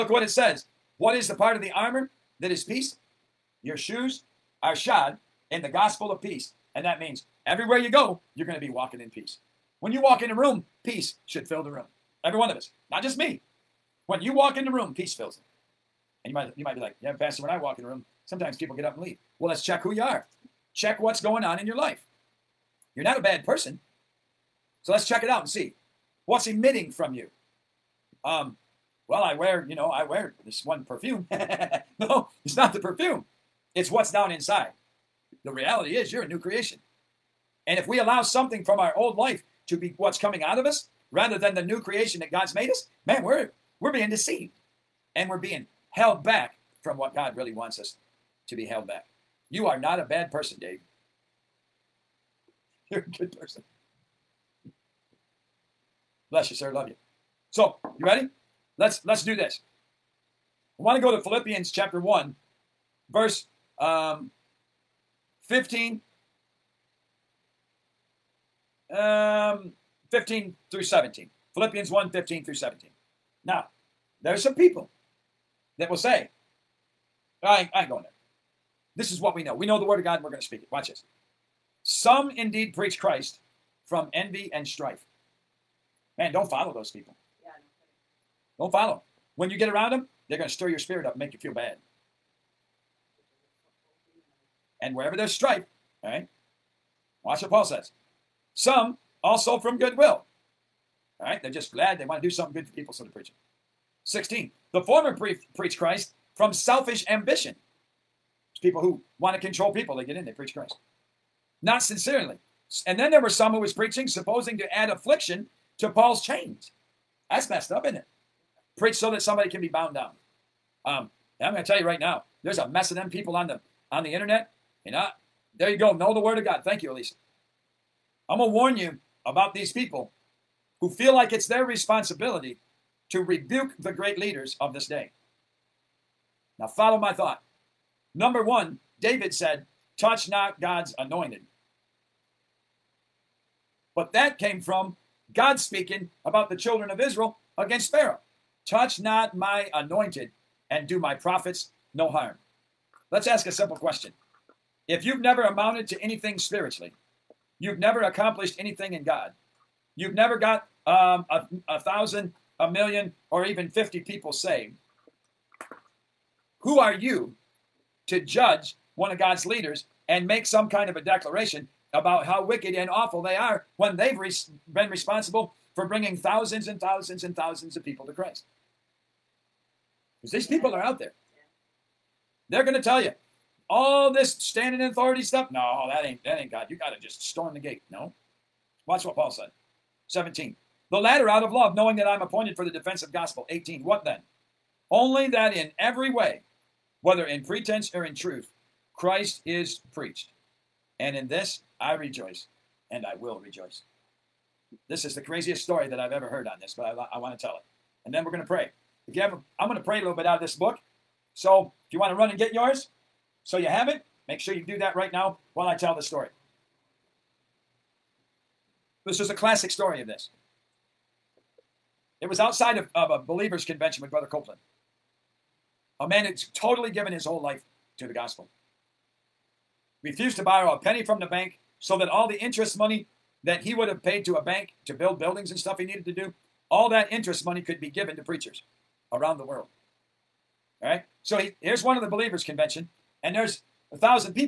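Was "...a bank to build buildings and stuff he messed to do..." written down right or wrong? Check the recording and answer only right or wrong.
wrong.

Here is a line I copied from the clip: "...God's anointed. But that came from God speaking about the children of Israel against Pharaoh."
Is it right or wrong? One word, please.
right.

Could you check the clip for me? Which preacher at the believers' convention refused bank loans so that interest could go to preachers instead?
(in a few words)
Brother Copeland.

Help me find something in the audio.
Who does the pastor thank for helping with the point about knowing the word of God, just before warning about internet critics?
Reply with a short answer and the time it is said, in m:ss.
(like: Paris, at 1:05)
Elisa, at 2:06.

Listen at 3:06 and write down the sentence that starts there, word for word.
You got to just storm the gate.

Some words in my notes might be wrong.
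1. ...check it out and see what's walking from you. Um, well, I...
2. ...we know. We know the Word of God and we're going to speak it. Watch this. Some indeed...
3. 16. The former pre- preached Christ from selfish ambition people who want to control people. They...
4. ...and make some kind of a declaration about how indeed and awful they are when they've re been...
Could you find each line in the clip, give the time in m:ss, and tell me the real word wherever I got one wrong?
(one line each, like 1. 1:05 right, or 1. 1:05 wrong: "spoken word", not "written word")
1. 0:25 wrong: "emitting", not "walking"
2. 1:19 right
3. 1:44 right
4. 2:50 wrong: "wicked", not "indeed".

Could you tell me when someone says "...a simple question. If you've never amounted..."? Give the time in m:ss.
2:33.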